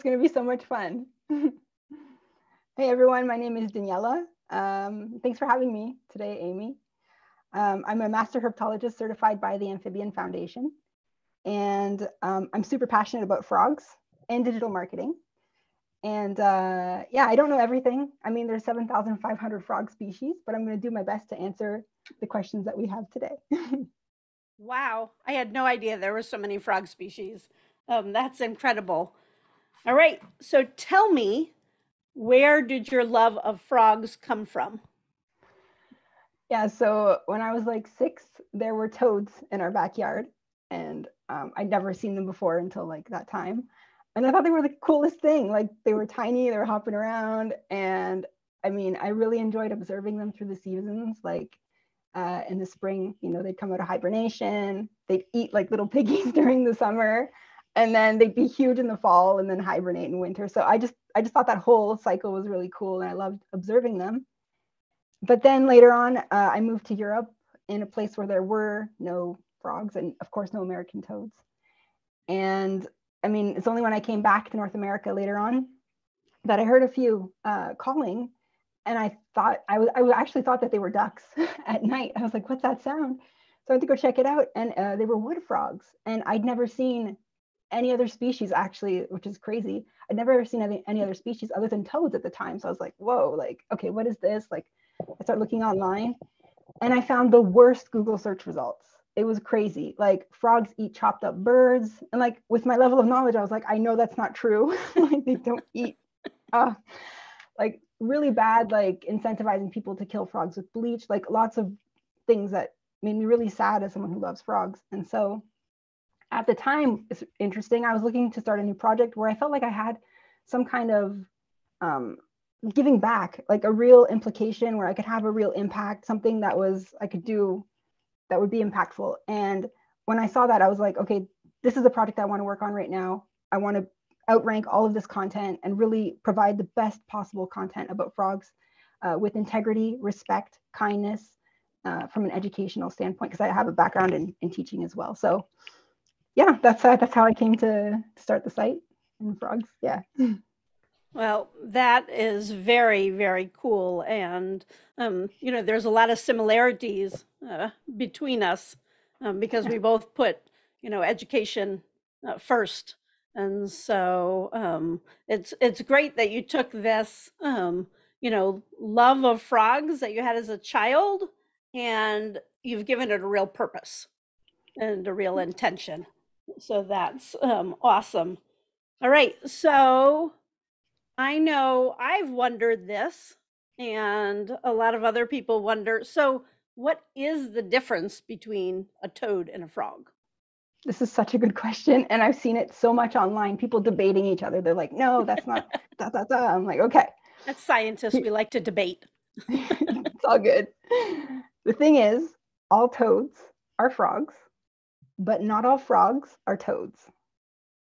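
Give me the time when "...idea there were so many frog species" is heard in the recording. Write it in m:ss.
0:25.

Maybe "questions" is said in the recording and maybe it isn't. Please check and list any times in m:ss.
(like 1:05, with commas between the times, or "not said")
0:22, 3:11.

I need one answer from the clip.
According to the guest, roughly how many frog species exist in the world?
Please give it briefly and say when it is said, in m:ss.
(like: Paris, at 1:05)
7,500, at 0:18.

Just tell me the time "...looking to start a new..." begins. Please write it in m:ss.
1:58.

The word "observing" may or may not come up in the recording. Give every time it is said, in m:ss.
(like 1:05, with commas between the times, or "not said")
0:49, 1:03.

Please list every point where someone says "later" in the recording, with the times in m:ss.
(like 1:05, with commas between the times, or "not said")
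1:05, 1:15.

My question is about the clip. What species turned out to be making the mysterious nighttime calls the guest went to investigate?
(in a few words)
Wood frogs.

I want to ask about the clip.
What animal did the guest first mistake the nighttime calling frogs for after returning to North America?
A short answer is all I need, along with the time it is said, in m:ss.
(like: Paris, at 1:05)
Ducks, at 1:20.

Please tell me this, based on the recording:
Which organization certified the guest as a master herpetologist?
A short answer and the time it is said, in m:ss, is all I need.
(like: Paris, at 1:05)
Amphibian Foundation, at 0:09.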